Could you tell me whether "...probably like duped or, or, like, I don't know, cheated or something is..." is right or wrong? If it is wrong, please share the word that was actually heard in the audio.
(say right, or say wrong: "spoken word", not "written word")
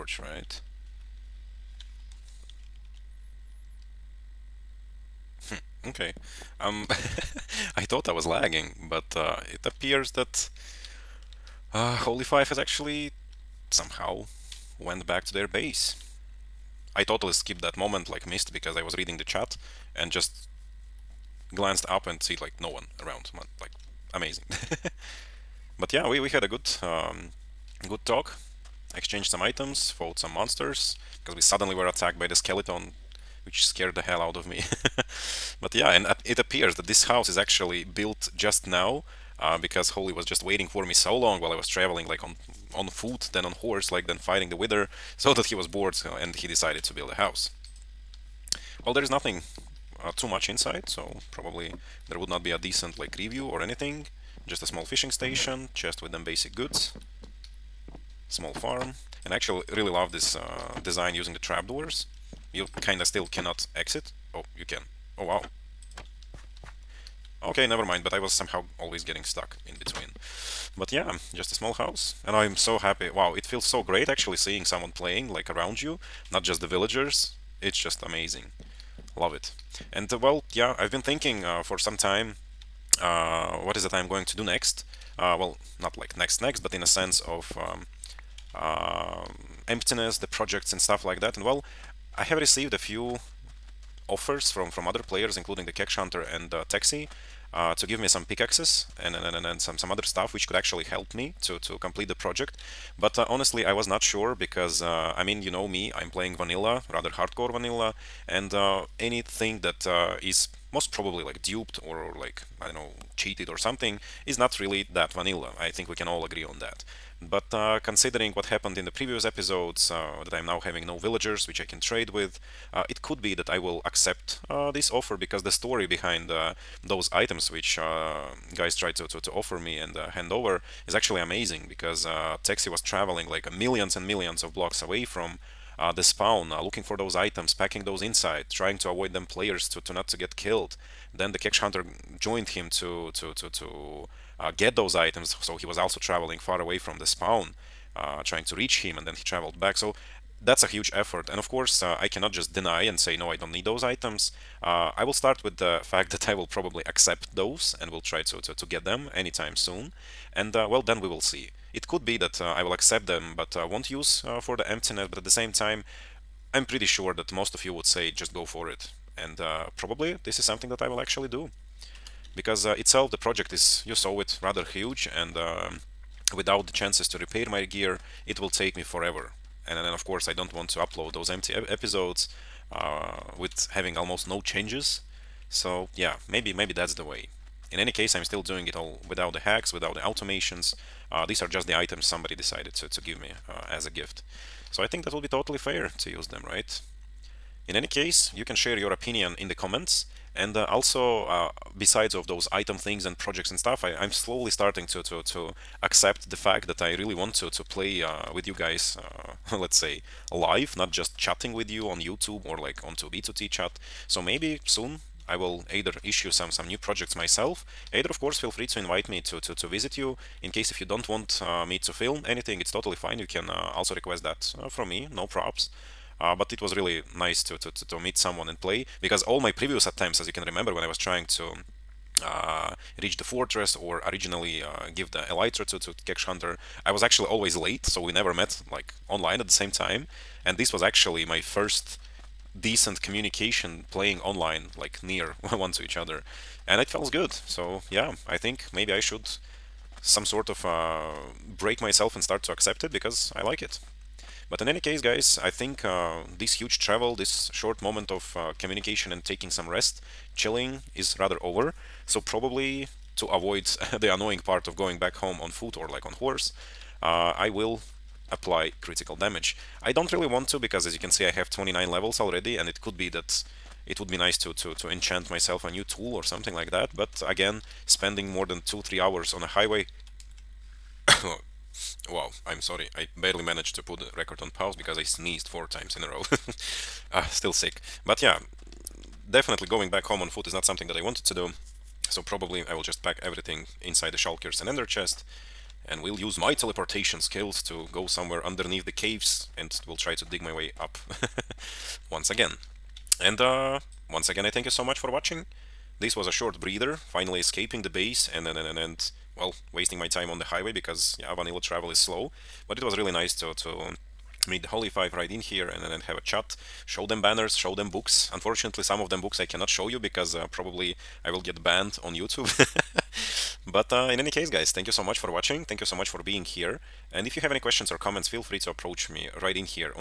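right.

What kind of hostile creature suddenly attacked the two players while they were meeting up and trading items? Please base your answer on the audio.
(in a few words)
Skeleton.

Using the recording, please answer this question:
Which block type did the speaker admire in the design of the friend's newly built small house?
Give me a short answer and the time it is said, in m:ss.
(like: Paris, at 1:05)
Trapdoors, at 1:01.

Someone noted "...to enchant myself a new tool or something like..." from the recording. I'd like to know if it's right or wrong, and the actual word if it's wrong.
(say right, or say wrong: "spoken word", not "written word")
right.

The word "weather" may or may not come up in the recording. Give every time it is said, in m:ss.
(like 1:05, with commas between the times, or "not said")
0:44.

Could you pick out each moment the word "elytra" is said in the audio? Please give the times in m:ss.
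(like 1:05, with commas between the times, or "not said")
3:55.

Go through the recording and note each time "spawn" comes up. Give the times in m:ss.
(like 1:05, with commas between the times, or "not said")
2:16, 2:27.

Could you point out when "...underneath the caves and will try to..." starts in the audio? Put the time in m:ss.
4:58.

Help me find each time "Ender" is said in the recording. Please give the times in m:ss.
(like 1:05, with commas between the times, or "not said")
4:54.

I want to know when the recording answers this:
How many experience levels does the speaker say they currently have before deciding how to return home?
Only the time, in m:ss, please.
4:31.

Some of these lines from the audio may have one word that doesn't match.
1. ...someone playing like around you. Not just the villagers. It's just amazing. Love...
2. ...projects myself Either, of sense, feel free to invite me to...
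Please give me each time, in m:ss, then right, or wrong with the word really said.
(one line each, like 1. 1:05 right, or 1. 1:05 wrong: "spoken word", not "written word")
1. 1:14 right
2. 3:36 wrong: "course", not "sense".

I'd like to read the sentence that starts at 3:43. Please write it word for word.
You can uh, also request that uh, from me, no props.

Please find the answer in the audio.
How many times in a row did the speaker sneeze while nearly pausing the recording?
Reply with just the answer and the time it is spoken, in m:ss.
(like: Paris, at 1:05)
4, at 4:45.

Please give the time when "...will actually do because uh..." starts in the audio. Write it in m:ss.
2:50.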